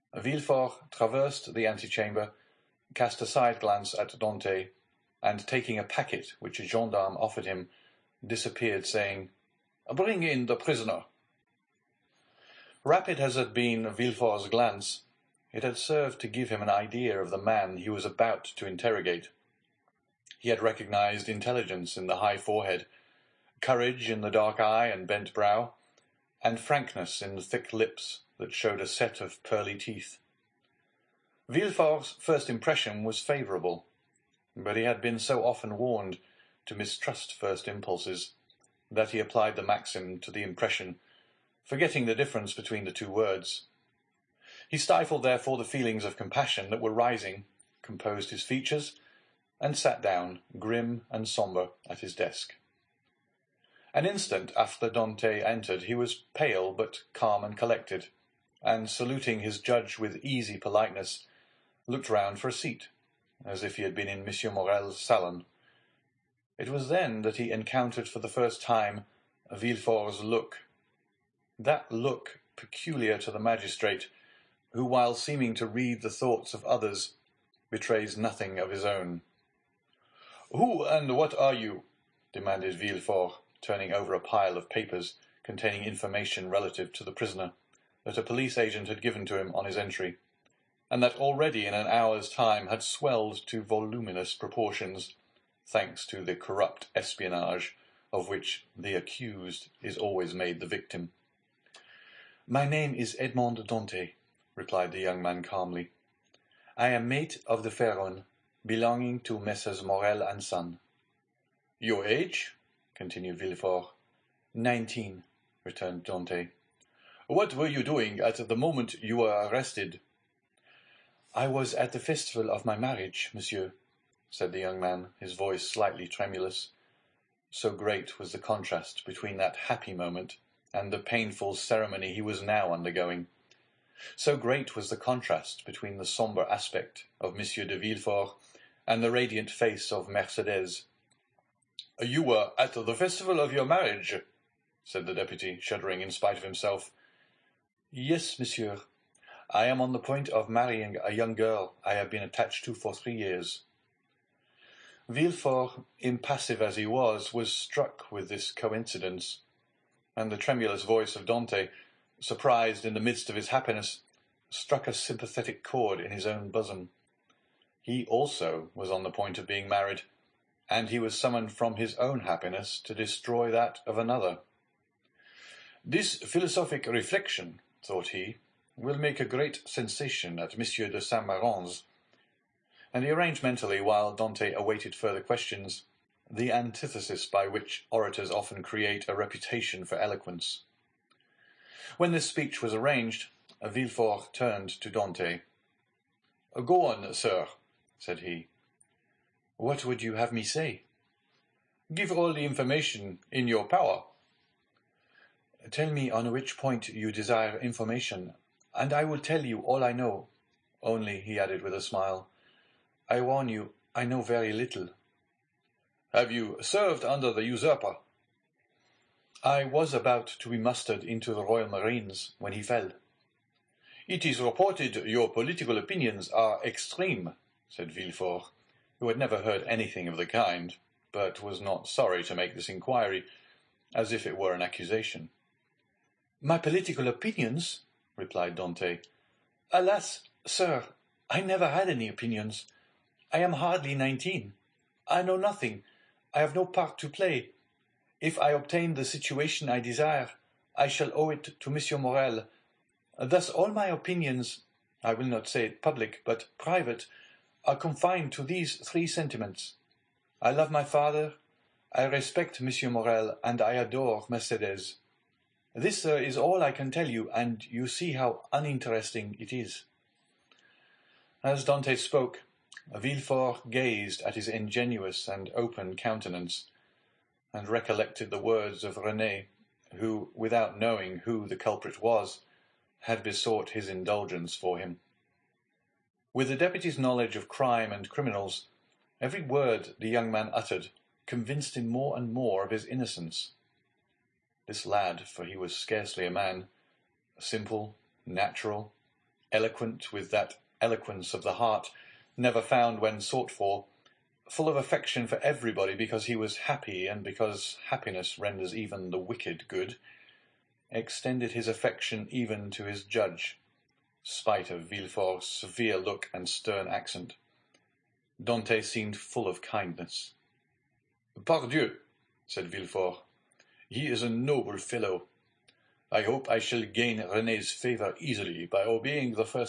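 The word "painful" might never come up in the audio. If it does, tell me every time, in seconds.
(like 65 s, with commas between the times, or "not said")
130 s.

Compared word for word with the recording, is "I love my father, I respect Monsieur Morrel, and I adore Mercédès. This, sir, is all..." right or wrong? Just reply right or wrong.
right.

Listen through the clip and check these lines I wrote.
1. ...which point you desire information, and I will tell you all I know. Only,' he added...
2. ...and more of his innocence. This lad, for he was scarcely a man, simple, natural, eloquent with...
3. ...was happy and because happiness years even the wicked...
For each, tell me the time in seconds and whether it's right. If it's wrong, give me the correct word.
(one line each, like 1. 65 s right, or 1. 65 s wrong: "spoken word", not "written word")
1. 206 s right
2. 292 s right
3. 306 s wrong: "renders", not "years".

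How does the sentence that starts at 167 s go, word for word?
He also was on the point of being married, and he was summoned from his own happiness to destroy that of another.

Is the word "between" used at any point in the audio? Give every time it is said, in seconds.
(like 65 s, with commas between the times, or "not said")
42 s, 129 s, 135 s.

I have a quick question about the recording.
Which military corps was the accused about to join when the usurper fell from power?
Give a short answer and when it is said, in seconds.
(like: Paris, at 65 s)
Royal Marines, at 221 s.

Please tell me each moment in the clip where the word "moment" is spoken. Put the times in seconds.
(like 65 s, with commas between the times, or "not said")
118 s, 129 s.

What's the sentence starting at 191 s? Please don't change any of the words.
When this speech was arranged, Villefort turned to Dantès.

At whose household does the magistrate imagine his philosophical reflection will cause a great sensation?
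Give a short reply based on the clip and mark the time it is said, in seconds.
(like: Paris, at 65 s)
Monsieur de Saint Méran, at 180 s.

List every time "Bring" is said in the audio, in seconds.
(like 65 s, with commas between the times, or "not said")
9 s.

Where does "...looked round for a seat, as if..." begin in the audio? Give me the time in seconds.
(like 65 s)
61 s.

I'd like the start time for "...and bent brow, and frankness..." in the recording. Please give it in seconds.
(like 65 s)
24 s.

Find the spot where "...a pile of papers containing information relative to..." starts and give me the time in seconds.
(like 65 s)
84 s.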